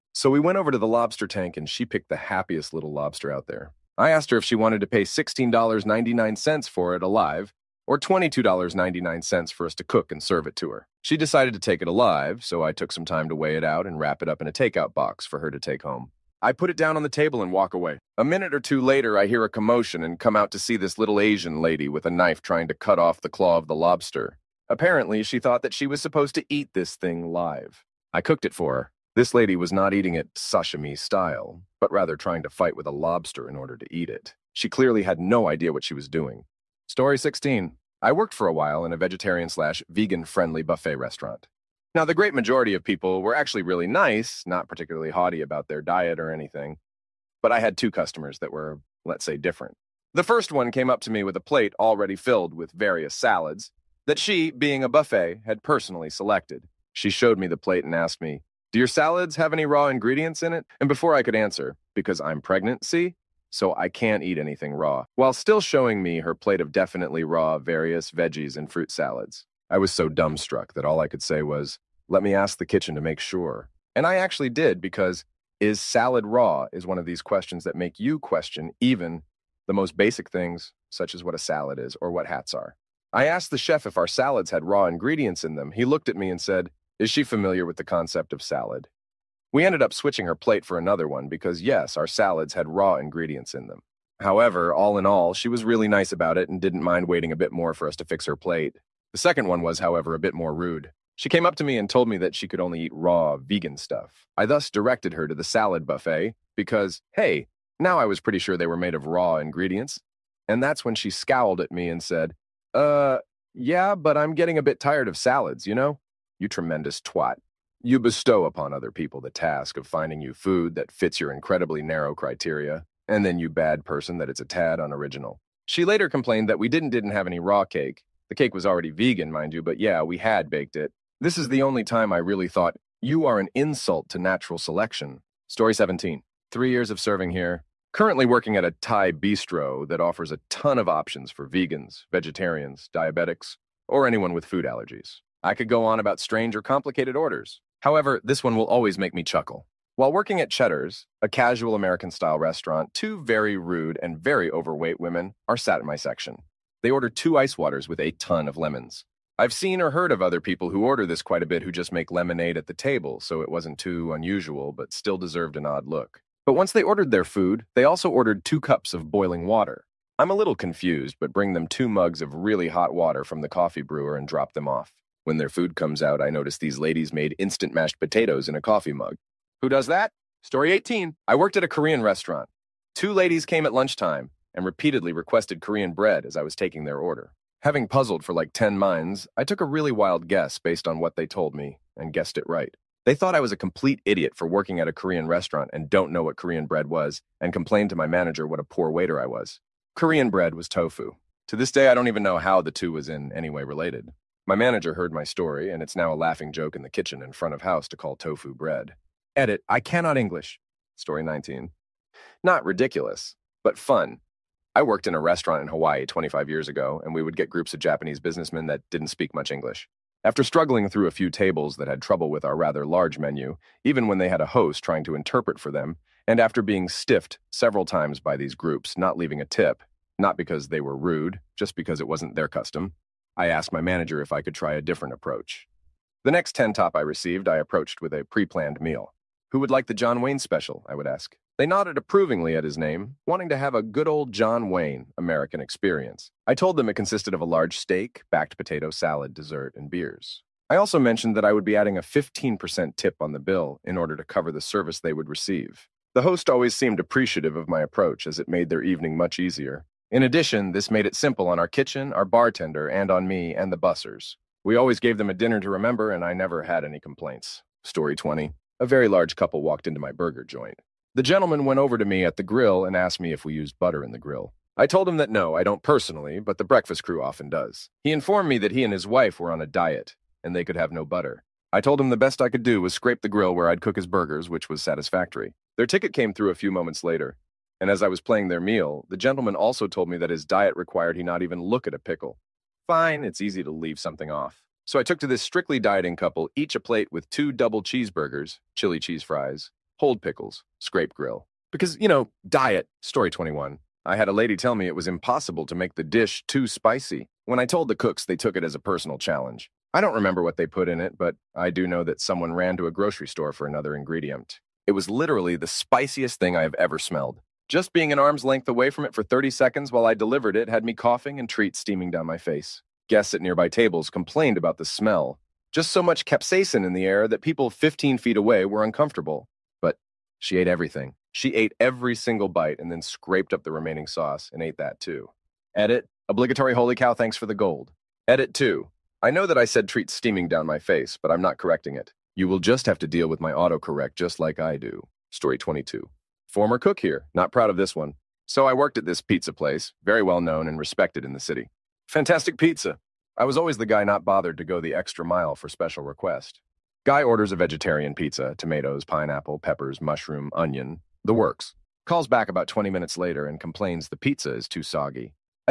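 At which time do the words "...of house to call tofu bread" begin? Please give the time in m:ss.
3:27.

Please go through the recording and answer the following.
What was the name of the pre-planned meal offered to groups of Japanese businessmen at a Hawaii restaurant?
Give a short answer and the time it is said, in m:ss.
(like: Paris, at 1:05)
John Wayne special, at 3:59.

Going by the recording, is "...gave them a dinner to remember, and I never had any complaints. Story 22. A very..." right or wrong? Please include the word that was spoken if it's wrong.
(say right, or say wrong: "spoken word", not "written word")
wrong: "20", not "22".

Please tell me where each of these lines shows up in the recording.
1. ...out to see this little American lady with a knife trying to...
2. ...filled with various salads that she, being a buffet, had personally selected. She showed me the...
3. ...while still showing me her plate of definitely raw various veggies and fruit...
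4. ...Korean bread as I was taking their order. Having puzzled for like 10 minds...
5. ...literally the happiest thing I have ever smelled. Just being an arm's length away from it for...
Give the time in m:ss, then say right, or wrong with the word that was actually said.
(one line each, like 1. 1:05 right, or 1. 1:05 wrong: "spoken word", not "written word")
1. 0:20 wrong: "Asian", not "American"
2. 0:52 right
3. 1:05 right
4. 3:05 right
5. 5:15 wrong: "spiciest", not "happiest".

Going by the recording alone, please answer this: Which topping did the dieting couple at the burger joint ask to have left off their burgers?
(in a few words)
Pickles.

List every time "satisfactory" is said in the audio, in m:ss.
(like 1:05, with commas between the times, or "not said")
4:44.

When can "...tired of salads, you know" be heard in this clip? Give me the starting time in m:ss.
1:54.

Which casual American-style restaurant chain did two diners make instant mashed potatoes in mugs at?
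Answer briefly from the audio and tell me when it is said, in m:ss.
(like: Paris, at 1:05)
Cheddar's, at 2:30.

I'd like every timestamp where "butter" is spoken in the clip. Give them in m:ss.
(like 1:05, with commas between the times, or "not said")
4:33, 4:41.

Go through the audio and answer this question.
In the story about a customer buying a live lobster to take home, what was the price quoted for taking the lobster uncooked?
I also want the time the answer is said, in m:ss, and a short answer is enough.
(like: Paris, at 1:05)
$16.99, at 0:05.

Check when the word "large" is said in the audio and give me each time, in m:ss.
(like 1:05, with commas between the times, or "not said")
3:42, 4:07, 4:29.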